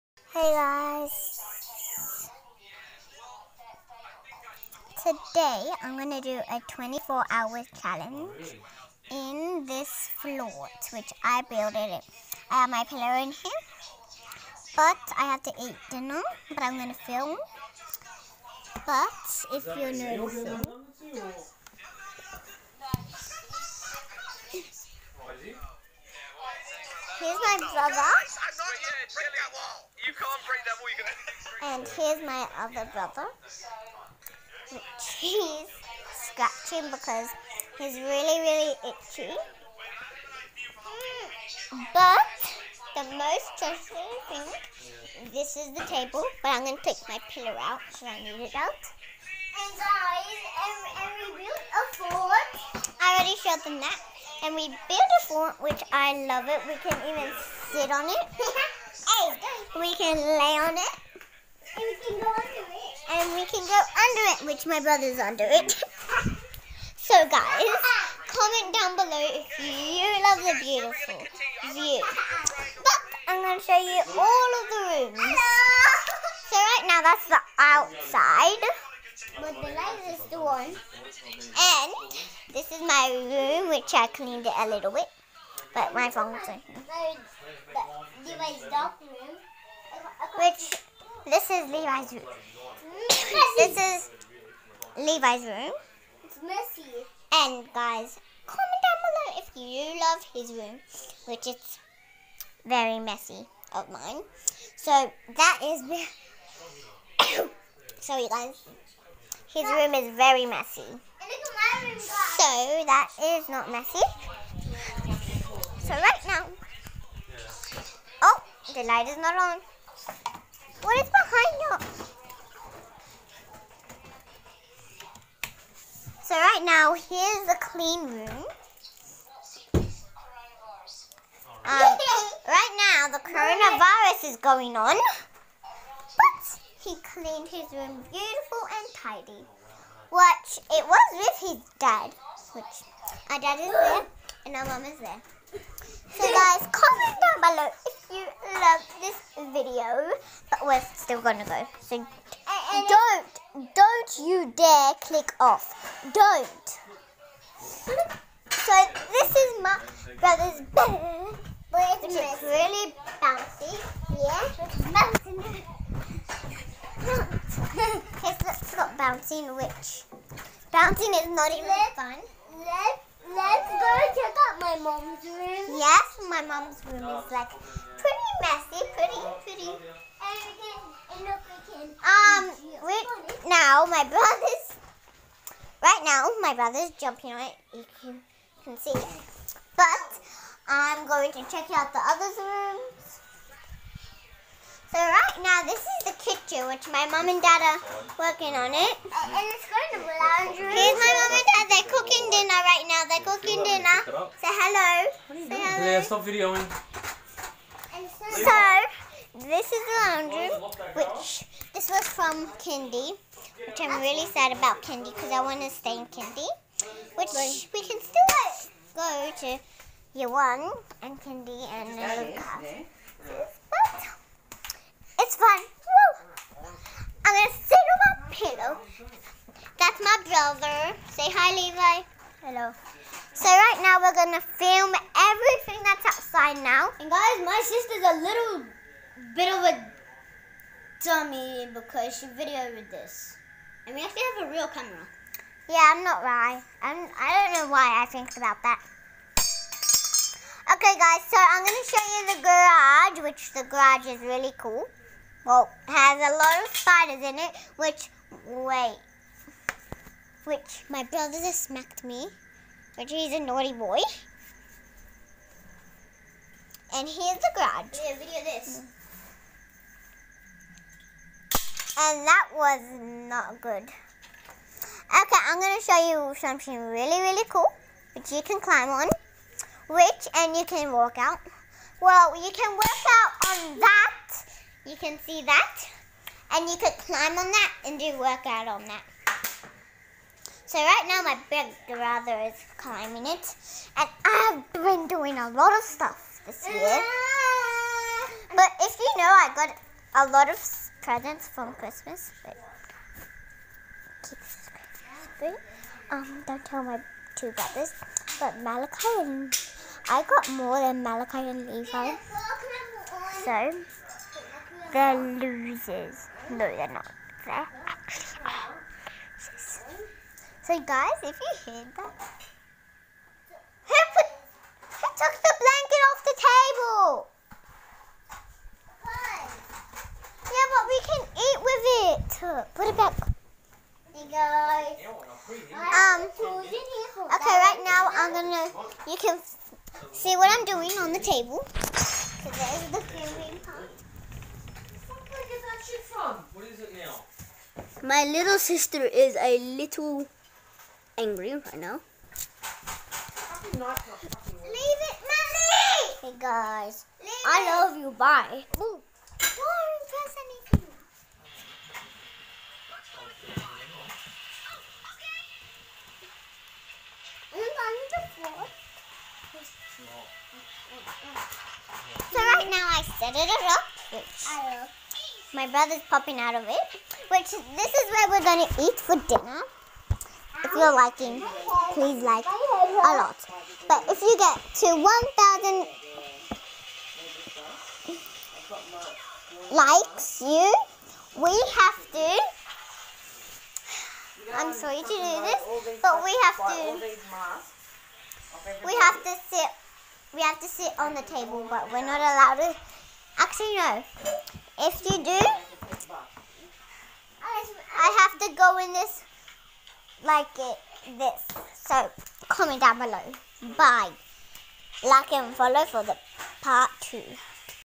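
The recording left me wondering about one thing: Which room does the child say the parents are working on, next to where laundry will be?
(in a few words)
the kitchen.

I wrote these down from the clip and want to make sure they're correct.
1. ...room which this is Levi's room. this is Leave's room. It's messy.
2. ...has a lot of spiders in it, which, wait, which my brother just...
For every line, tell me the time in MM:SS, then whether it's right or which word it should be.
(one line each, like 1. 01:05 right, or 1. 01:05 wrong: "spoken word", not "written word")
1. 01:28 wrong: "Levi", not "Leave"
2. 04:15 right.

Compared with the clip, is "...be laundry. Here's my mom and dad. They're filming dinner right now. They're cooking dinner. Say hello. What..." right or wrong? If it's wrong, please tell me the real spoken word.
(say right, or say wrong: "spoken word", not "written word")
wrong: "cooking", not "filming".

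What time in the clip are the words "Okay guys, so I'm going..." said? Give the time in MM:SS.
04:10.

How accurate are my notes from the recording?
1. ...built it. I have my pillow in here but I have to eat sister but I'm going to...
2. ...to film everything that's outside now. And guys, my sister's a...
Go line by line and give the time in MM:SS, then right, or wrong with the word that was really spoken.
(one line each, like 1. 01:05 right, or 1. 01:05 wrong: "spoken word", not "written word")
1. 00:11 wrong: "dinner", not "sister"
2. 03:54 right.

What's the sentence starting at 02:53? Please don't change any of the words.
Let's go check out my mom's room.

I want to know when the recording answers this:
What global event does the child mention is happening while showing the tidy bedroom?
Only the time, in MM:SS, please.
02:13.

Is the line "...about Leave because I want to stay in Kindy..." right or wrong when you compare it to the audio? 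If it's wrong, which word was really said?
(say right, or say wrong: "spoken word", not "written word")
wrong: "Kindy", not "Leave".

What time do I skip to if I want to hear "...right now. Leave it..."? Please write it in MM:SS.
05:51.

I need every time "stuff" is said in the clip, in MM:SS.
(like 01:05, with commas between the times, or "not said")
04:55.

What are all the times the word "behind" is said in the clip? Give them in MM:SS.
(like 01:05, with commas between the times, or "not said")
02:01.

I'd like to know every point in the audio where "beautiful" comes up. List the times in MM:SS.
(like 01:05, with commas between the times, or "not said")
01:10, 02:18.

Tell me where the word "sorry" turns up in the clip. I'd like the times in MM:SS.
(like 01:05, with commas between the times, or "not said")
01:47, 06:34.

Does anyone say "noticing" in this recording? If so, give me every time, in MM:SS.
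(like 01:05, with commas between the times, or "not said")
00:20.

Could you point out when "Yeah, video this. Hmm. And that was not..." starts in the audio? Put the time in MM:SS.
04:28.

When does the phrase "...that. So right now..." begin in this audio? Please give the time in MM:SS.
04:48.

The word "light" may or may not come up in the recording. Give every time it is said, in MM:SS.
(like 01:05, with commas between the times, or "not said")
01:19, 01:58.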